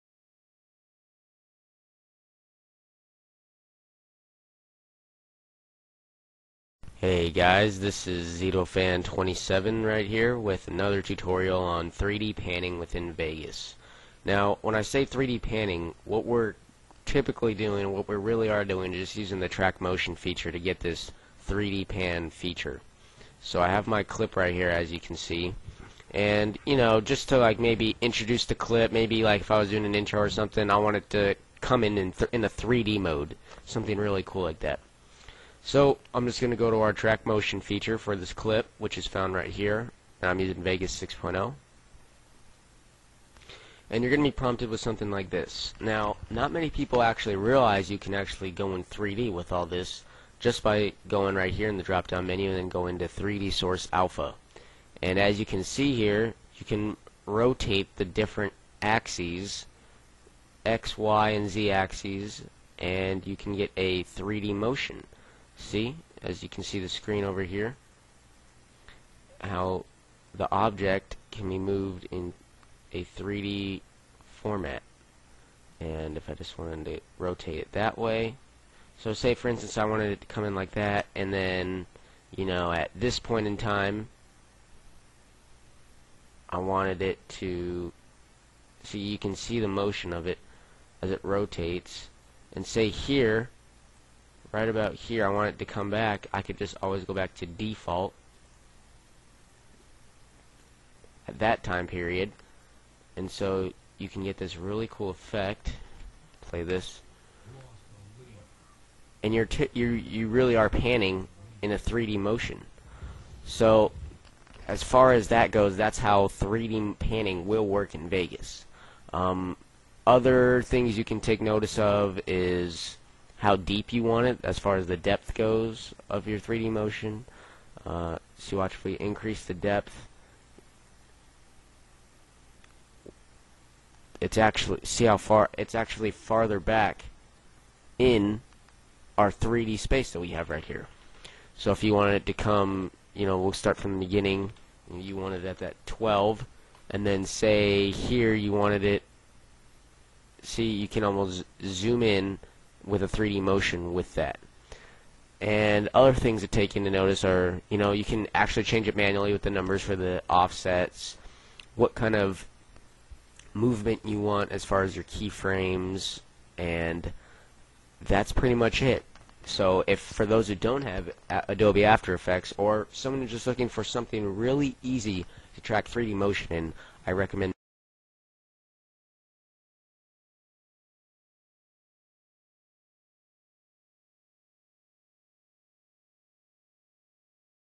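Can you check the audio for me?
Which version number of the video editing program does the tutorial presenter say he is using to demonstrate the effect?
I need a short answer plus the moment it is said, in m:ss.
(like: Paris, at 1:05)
6.0, at 0:40.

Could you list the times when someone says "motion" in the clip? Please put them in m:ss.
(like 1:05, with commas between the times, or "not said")
0:19, 0:37, 1:04, 1:29, 1:52, 2:06, 2:33, 2:56.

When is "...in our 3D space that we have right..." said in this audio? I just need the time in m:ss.
2:17.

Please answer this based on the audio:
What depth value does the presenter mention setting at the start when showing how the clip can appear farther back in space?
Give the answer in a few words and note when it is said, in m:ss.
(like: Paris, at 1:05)
12, at 2:25.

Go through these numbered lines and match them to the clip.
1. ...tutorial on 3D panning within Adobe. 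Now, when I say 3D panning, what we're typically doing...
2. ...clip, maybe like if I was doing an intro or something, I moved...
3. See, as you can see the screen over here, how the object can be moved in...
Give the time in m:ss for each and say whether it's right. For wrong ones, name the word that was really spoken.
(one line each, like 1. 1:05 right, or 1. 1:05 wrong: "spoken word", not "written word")
1. 0:11 wrong: "Vegas", not "Adobe"
2. 0:28 wrong: "wanted", not "moved"
3. 1:05 right.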